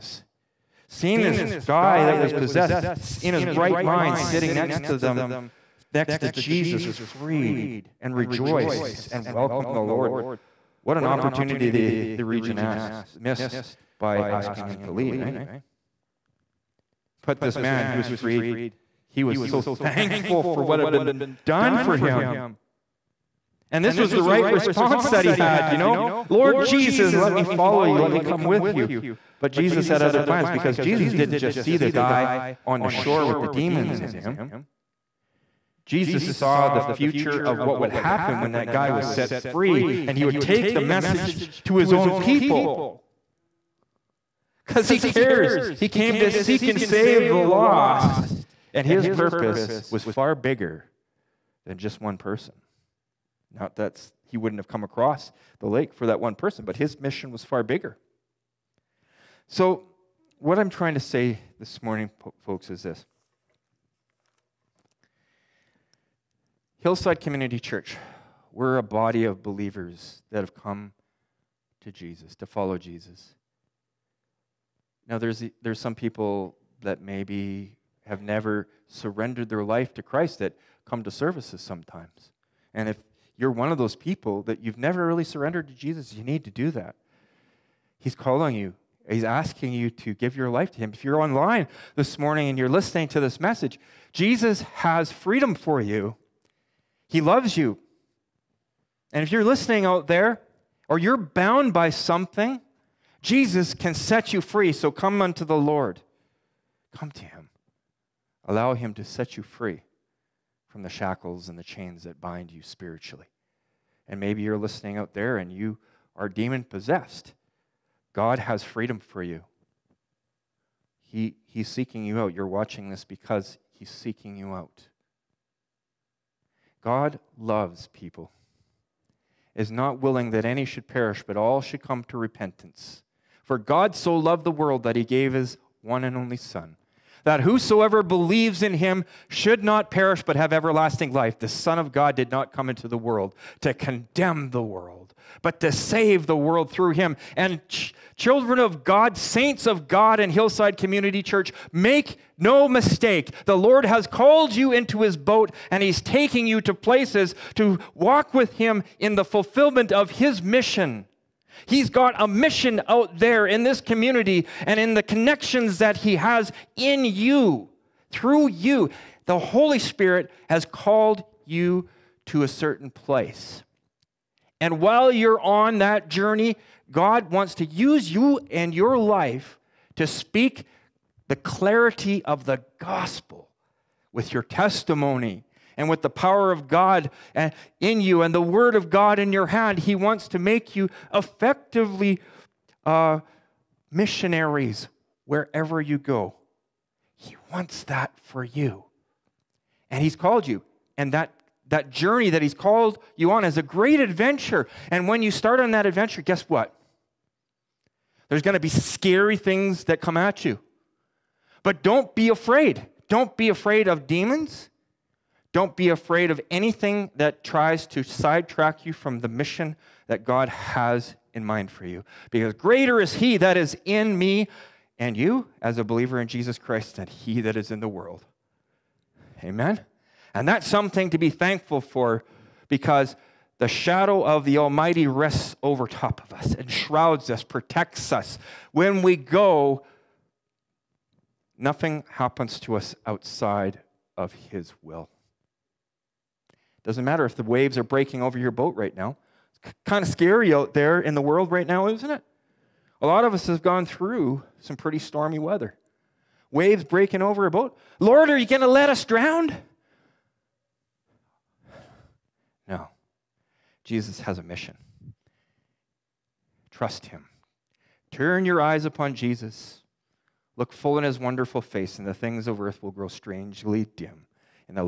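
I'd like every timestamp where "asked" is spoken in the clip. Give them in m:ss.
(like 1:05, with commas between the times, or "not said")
0:12.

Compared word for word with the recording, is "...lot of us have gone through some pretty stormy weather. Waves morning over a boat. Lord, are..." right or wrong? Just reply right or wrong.
wrong.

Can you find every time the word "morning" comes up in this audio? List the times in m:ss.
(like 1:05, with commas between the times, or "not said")
1:01, 1:32.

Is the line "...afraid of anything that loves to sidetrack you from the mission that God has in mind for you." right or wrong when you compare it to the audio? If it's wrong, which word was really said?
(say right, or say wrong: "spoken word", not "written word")
wrong: "tries", not "loves".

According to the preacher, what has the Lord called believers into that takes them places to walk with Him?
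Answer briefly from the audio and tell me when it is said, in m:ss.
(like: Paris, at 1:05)
his boat, at 2:35.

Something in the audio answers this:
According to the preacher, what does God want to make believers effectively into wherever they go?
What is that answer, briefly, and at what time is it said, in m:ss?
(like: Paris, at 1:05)
missionaries, at 3:13.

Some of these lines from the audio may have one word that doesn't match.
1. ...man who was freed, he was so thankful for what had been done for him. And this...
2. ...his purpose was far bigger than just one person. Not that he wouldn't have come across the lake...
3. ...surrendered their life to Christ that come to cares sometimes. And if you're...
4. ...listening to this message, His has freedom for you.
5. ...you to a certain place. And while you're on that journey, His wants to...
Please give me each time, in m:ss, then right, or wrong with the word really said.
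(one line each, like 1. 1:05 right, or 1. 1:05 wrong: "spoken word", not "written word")
1. 0:17 right
2. 0:48 right
3. 1:18 wrong: "services", not "cares"
4. 1:32 wrong: "Jesus", not "His"
5. 2:51 wrong: "God", not "His".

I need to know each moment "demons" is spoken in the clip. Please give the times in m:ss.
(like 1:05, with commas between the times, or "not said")
0:33, 1:56, 3:34.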